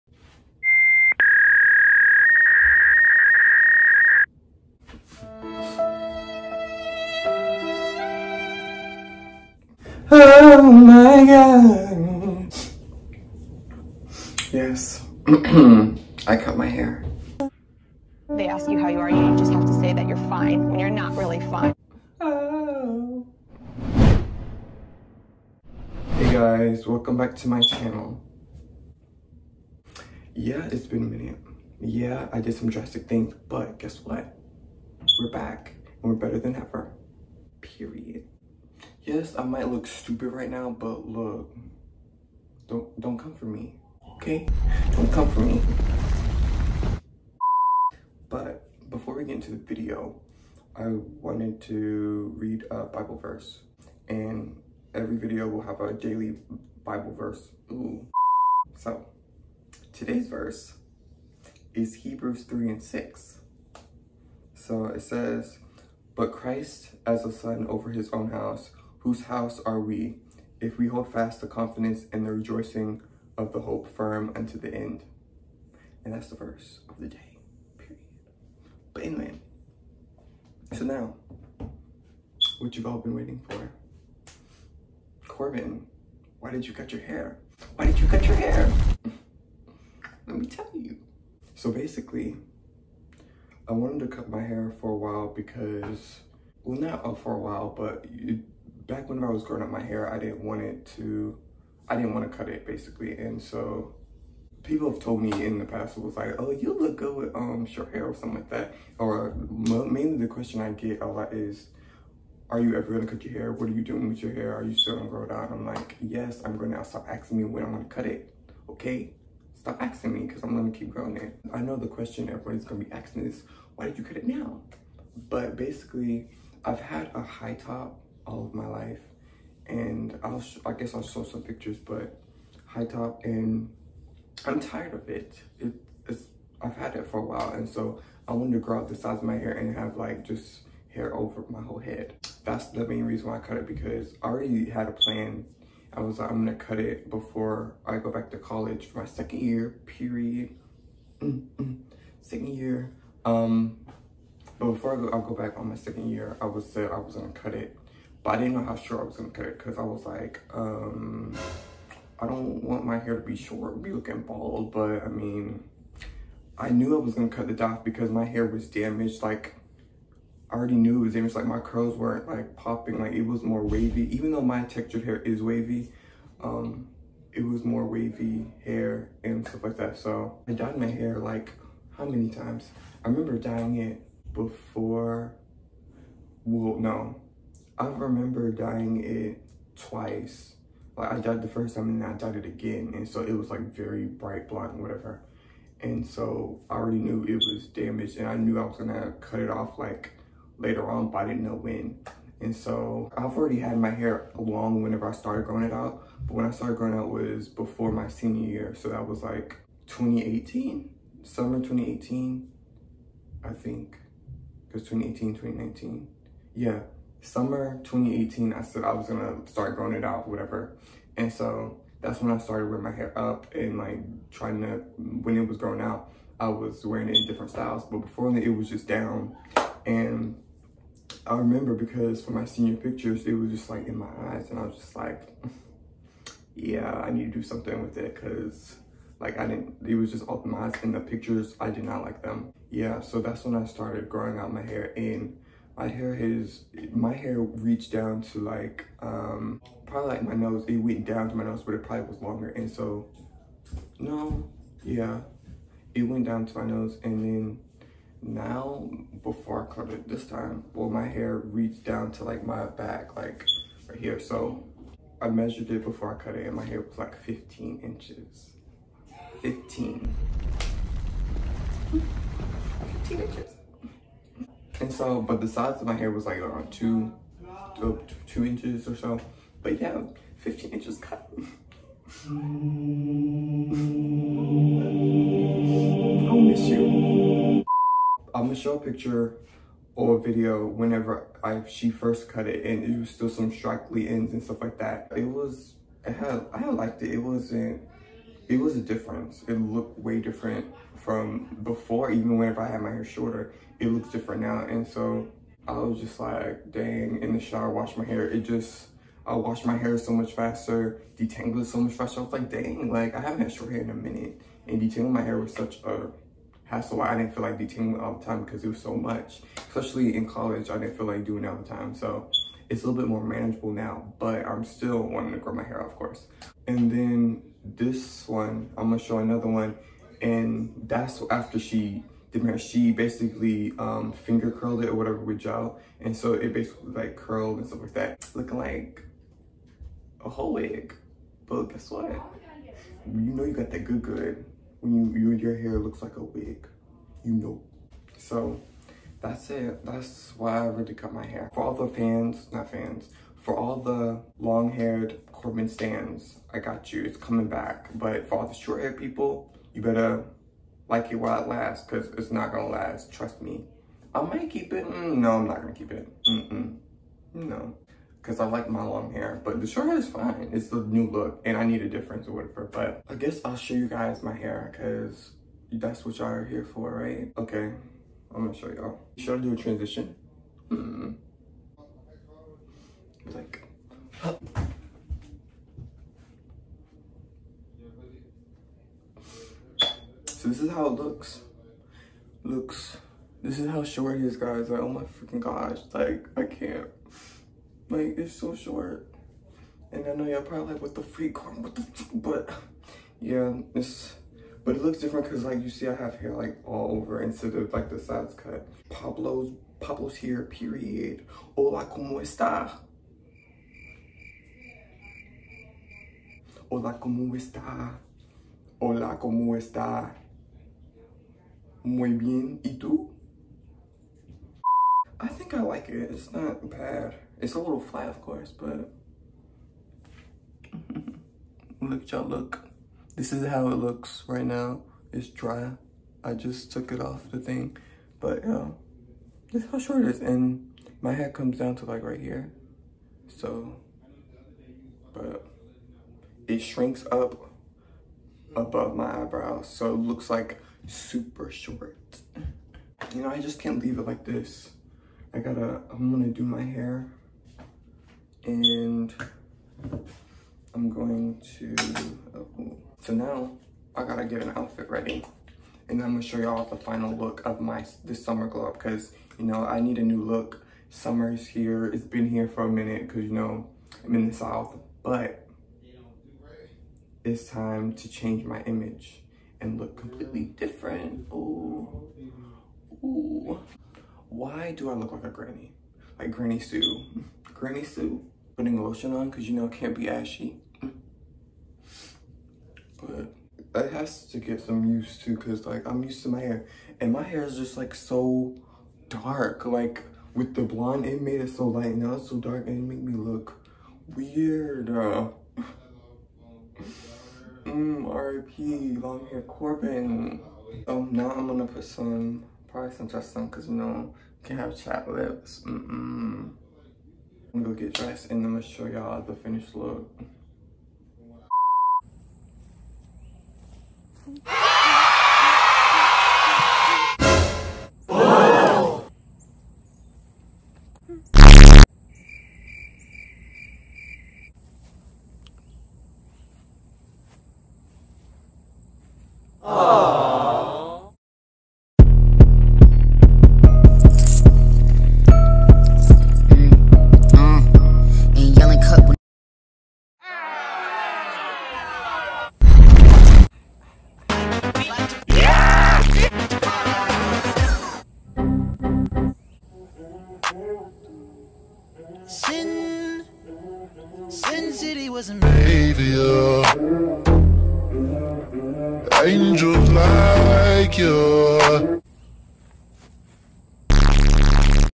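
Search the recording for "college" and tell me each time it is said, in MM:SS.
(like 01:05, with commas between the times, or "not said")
02:28, 05:20.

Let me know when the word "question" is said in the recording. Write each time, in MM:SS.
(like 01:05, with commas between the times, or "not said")
01:50, 02:01.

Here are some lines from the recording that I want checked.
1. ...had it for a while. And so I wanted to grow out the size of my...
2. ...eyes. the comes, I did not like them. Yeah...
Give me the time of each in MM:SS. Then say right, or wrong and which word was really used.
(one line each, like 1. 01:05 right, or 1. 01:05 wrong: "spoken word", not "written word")
1. 02:16 right
2. 04:00 wrong: "pictures", not "comes".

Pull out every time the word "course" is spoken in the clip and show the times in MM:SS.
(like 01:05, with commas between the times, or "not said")
05:25, 07:08.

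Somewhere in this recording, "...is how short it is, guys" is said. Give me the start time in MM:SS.
06:33.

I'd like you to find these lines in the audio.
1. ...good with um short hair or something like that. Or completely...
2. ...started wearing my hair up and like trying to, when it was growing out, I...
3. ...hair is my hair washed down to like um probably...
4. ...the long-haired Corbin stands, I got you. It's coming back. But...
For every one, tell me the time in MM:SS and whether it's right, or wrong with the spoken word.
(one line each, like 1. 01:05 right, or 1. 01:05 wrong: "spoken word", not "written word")
1. 01:46 wrong: "mainly", not "completely"
2. 03:42 right
3. 04:05 wrong: "reached", not "washed"
4. 05:53 right.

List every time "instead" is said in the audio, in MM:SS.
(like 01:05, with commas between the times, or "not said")
06:47.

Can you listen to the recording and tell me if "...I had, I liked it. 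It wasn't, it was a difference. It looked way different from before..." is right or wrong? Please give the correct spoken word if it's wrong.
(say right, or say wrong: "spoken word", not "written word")
right.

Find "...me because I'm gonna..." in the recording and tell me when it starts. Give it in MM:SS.
02:00.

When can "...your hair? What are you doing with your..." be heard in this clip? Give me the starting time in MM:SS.
01:53.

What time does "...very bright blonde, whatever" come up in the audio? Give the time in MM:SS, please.
03:13.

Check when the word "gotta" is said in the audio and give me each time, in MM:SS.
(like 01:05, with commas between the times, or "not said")
07:35, 07:44.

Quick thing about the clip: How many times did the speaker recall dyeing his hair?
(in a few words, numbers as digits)
2.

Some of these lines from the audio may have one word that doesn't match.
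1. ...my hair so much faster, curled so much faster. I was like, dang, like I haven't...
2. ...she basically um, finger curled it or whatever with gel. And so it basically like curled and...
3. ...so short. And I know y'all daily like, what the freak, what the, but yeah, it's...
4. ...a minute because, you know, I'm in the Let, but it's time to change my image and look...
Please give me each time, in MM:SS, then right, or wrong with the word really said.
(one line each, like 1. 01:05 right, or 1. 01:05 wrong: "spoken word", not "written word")
1. 05:09 wrong: "detangled", not "curled"
2. 05:32 right
3. 06:38 wrong: "probably", not "daily"
4. 07:52 wrong: "South", not "Let".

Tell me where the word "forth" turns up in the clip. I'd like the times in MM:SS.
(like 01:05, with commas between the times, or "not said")
not said.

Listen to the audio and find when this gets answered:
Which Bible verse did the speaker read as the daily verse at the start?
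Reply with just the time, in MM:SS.
01:01.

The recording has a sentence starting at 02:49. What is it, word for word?
Like, I already knew it was damaged.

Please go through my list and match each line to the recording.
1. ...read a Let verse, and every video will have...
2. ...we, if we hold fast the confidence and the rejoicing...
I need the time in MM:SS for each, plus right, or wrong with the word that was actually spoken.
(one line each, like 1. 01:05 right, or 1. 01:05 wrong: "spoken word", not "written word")
1. 00:52 wrong: "Bible", not "Let"
2. 01:09 right.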